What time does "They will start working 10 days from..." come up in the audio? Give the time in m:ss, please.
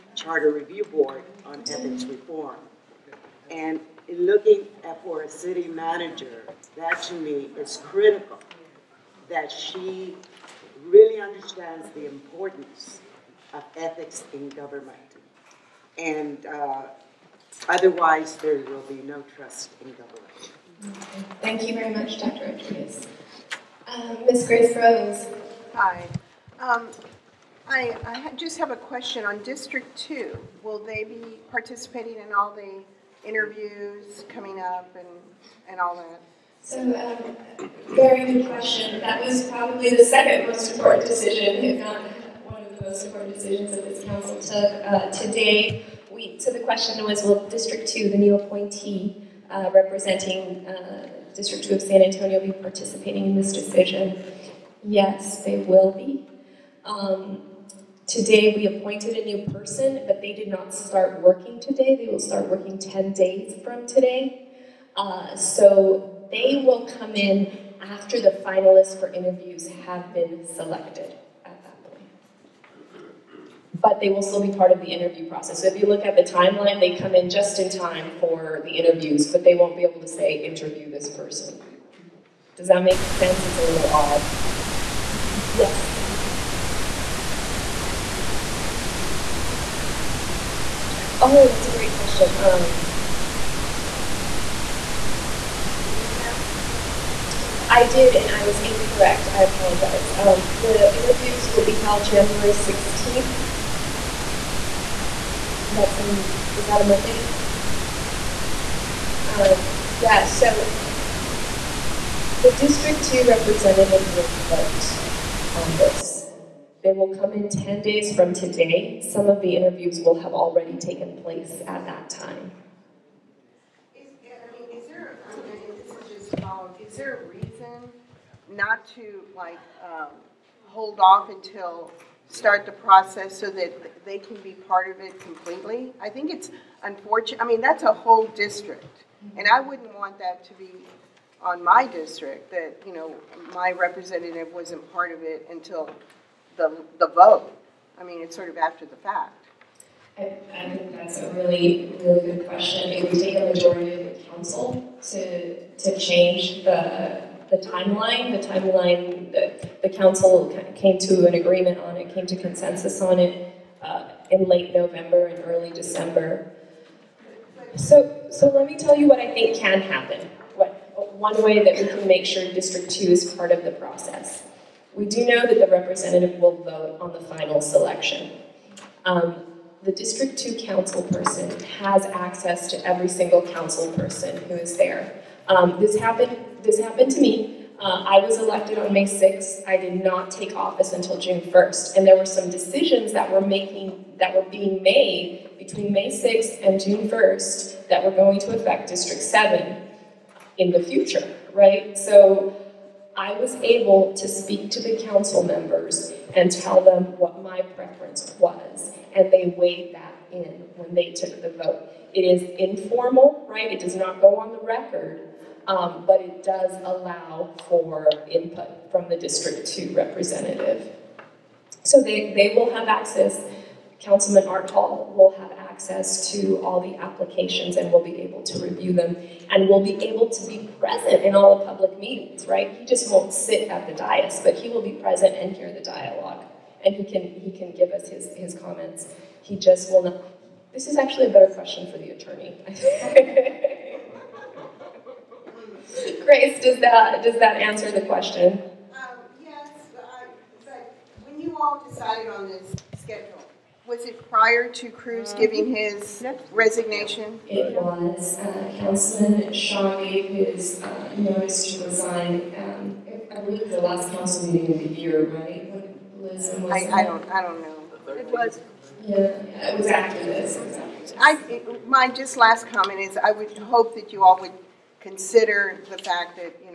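1:01.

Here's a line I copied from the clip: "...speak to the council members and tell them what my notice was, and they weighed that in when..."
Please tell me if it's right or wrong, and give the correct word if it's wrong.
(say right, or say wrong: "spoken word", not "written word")
wrong: "preference", not "notice".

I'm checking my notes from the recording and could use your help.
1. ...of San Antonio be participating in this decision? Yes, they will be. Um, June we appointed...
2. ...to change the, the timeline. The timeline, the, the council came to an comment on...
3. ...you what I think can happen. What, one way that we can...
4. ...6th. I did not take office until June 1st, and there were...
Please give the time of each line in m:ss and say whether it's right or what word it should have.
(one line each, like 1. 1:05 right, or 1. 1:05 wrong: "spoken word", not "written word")
1. 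0:51 wrong: "Today", not "June"
2. 2:35 wrong: "agreement", not "comment"
3. 2:48 right
4. 3:09 right.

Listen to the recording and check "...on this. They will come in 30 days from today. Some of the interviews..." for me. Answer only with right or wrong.
wrong.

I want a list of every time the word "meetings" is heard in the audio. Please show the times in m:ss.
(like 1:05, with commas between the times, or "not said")
3:51, 4:24.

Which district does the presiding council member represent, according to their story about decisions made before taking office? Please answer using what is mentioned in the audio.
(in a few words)
District 7.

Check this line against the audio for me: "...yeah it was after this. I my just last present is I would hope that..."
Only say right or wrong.
wrong.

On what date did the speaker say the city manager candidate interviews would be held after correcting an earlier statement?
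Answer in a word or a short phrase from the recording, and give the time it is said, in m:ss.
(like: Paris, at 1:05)
January 16th, at 1:42.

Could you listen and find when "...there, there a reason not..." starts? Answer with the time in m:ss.
2:04.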